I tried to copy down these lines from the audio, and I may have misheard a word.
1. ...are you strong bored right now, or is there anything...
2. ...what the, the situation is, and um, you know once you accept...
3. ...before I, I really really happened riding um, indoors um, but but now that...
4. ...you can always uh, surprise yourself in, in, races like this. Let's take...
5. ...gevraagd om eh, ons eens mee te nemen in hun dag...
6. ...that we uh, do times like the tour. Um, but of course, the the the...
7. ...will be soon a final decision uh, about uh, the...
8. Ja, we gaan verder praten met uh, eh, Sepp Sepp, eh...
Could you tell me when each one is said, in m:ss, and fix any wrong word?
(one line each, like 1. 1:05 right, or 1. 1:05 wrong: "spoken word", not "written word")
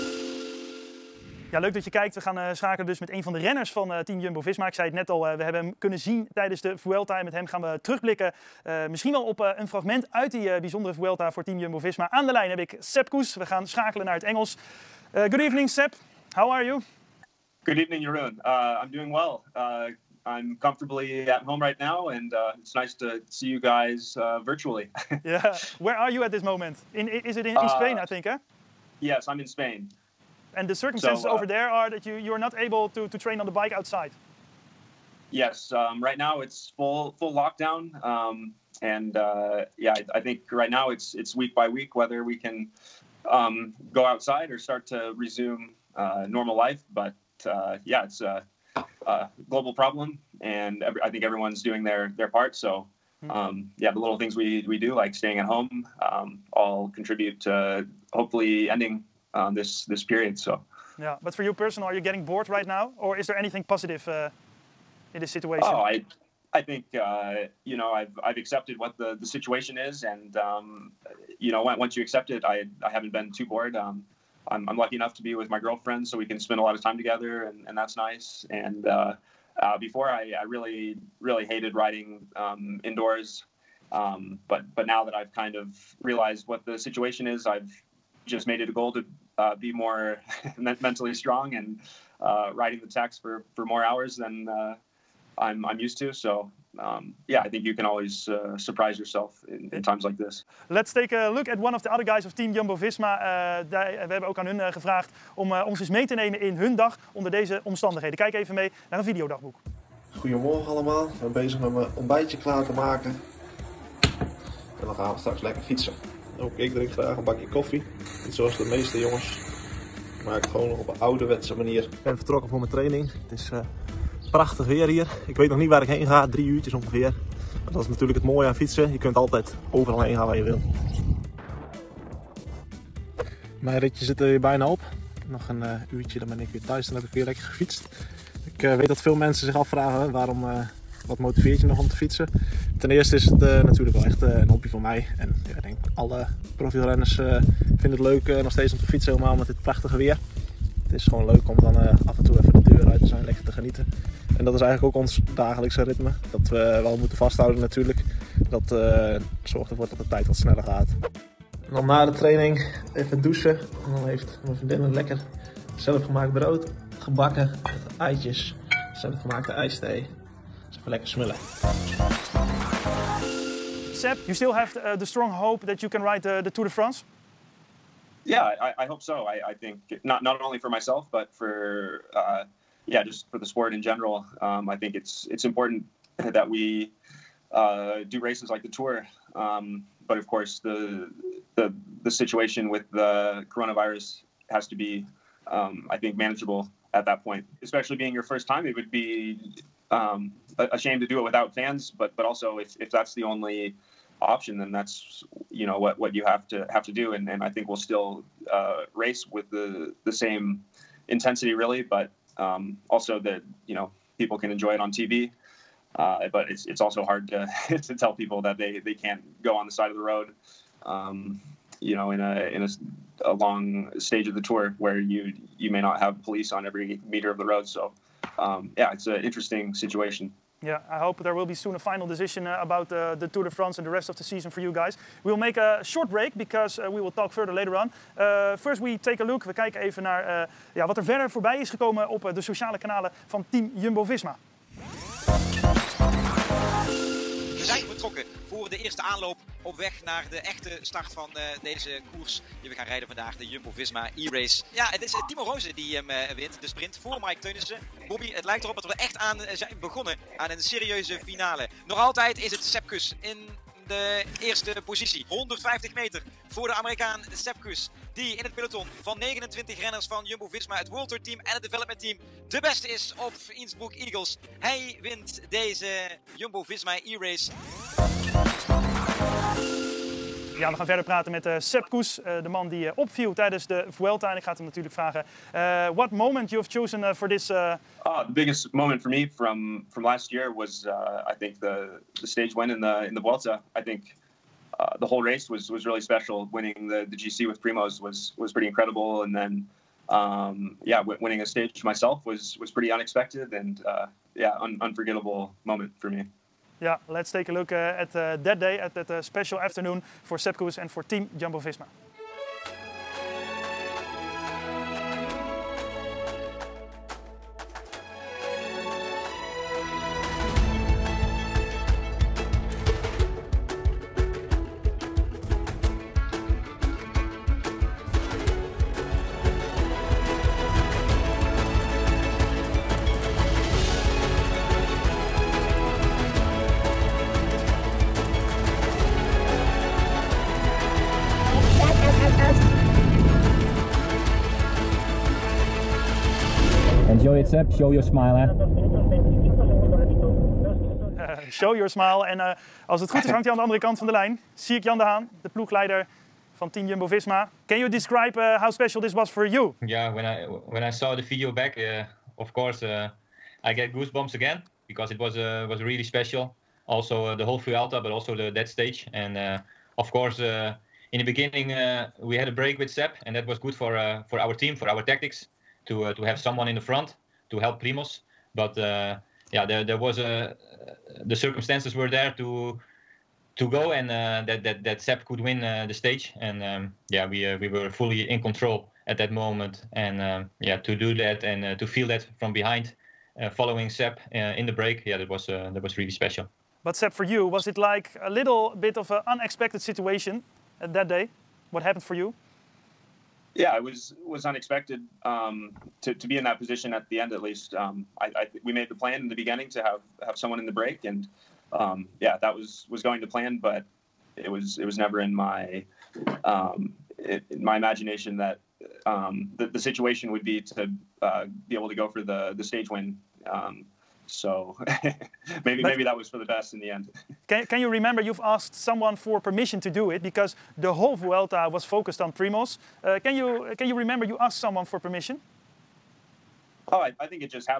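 1. 1:01 wrong: "getting", not "strong"
2. 1:08 right
3. 1:19 wrong: "hated", not "happened"
4. 1:37 wrong: "times", not "races"
5. 1:44 right
6. 3:06 wrong: "races", not "times"
7. 3:51 right
8. 4:40 wrong: "Koes", not "Sepp".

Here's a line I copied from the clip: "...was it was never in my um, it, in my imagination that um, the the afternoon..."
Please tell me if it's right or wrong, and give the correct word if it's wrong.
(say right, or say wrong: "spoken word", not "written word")
wrong: "situation", not "afternoon".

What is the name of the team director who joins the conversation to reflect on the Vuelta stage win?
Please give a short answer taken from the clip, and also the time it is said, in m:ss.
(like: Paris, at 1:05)
Sierk Jan de Haan, at 5:54.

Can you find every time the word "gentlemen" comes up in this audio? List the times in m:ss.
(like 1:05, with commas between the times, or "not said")
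not said.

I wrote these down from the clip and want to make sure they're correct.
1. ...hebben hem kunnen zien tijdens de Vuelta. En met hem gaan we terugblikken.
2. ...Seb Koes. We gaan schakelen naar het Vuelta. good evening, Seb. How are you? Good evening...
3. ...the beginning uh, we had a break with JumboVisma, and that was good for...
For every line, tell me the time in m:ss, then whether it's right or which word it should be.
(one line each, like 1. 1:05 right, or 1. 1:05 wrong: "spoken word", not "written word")
1. 0:05 right
2. 0:12 wrong: "Engels", not "Vuelta"
3. 6:11 wrong: "Sepp", not "JumboVisma".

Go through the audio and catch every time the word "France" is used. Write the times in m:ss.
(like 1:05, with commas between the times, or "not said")
2:56, 3:53.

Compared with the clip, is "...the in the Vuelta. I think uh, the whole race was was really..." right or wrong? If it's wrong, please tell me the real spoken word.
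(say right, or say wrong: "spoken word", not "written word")
right.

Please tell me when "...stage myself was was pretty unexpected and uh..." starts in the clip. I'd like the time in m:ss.
5:01.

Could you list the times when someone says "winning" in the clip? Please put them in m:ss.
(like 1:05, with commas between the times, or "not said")
4:56, 5:01.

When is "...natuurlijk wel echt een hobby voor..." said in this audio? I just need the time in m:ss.
2:23.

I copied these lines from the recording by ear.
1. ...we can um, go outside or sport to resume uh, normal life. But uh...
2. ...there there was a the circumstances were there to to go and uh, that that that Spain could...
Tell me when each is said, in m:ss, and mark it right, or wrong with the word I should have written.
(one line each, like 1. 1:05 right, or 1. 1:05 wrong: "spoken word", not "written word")
1. 0:42 wrong: "start", not "sport"
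2. 6:19 wrong: "Sepp", not "Spain".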